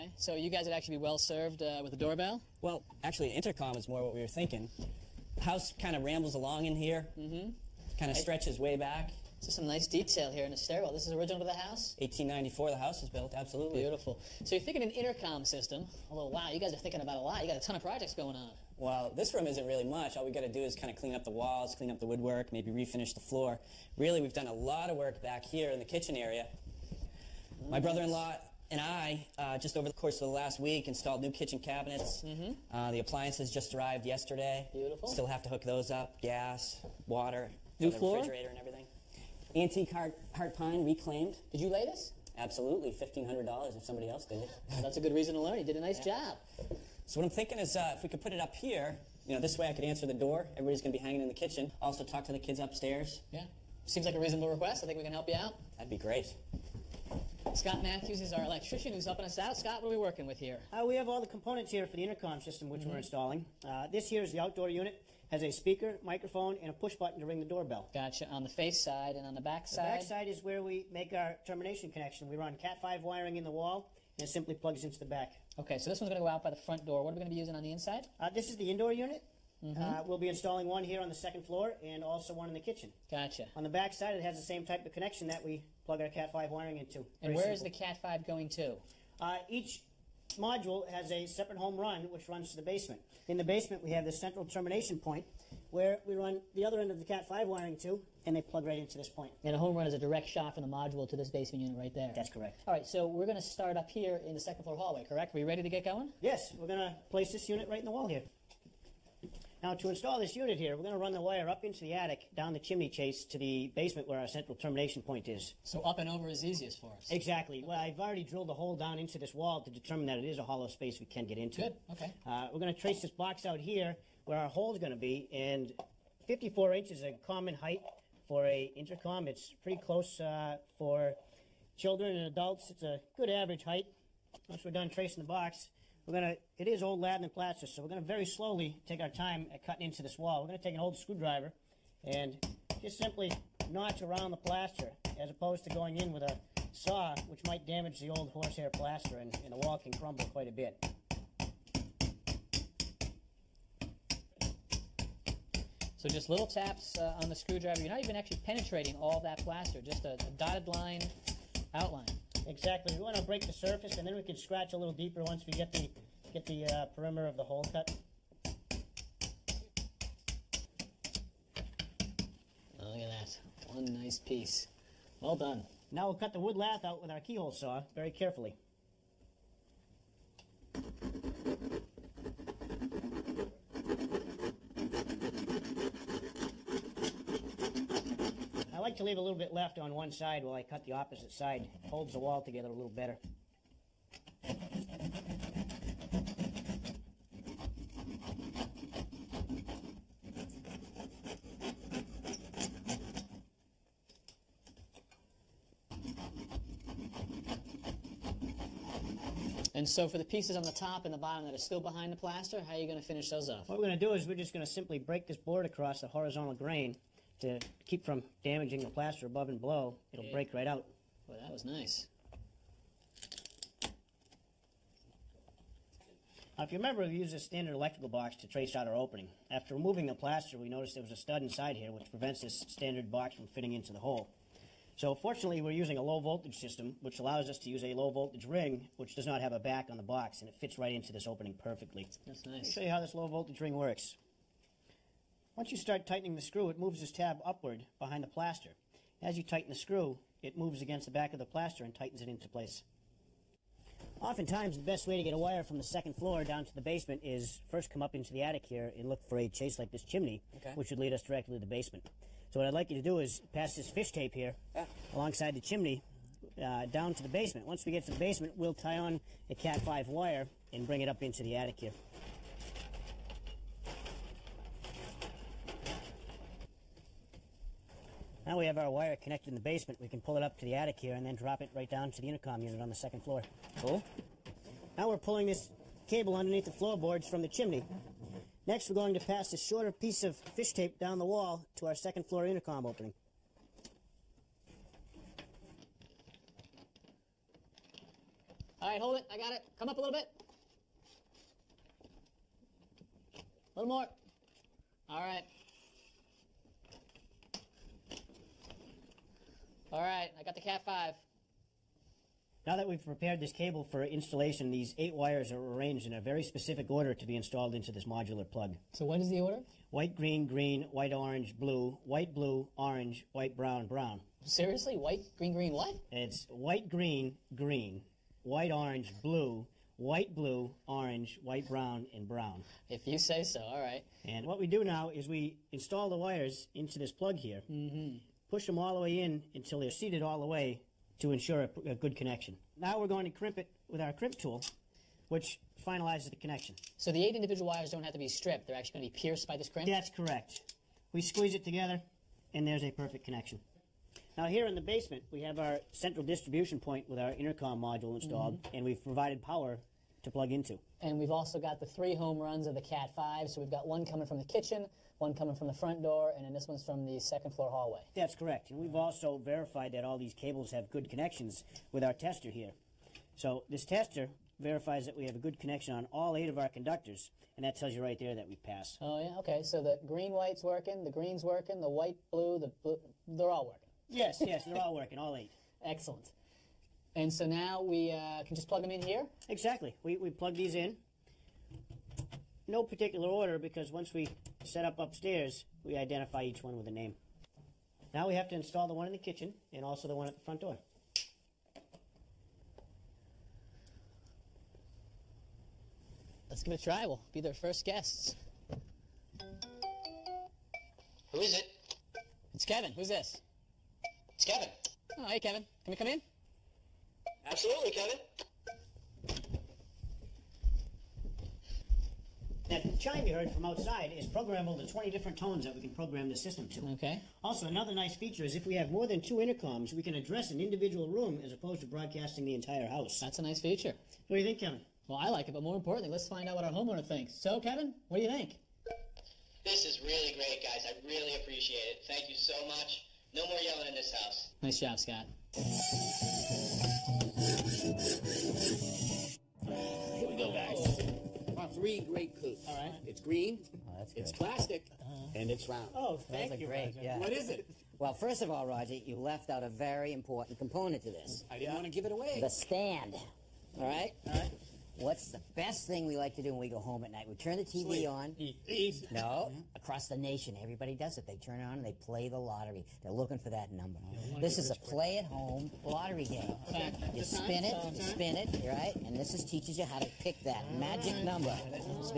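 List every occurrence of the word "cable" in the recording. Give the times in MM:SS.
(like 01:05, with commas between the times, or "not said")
04:46, 05:13, 06:10.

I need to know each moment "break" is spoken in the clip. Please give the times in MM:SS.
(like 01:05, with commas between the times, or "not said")
02:43, 03:34, 03:40.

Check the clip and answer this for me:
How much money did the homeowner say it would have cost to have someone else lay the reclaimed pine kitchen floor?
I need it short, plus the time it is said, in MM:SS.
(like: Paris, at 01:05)
$1,500, at 00:42.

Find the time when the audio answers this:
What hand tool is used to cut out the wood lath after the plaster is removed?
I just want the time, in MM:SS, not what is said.
02:57.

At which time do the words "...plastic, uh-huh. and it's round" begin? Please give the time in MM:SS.
07:34.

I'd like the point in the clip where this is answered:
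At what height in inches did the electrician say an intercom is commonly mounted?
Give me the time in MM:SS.
02:06.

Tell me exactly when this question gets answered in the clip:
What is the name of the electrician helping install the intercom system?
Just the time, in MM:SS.
00:57.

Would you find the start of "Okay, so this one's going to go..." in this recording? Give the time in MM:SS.
01:15.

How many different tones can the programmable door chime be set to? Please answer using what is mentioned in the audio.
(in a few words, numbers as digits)
20.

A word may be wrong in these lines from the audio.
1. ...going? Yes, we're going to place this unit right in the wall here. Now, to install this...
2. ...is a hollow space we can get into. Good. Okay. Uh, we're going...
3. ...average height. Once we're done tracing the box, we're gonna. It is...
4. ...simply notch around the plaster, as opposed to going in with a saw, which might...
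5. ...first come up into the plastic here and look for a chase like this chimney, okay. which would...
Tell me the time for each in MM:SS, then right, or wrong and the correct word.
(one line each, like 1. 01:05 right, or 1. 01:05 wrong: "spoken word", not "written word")
1. 01:45 right
2. 02:00 right
3. 02:13 right
4. 02:22 right
5. 04:17 wrong: "attic", not "plastic".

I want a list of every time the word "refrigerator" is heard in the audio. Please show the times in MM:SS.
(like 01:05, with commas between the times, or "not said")
00:38.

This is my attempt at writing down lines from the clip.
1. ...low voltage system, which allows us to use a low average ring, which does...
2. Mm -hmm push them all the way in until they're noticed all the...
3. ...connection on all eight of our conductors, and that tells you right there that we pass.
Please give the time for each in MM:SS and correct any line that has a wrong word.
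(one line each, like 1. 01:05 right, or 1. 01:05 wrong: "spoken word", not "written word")
1. 03:56 wrong: "voltage", not "average"
2. 05:37 wrong: "seated", not "noticed"
3. 06:15 right.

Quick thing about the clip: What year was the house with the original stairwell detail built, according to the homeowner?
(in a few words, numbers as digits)
1894.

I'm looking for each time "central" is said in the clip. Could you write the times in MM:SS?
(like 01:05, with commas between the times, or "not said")
01:34, 01:54, 05:55.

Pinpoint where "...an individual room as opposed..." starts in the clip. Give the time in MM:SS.
07:10.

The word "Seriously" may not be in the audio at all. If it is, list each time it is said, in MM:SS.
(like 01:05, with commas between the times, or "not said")
05:24.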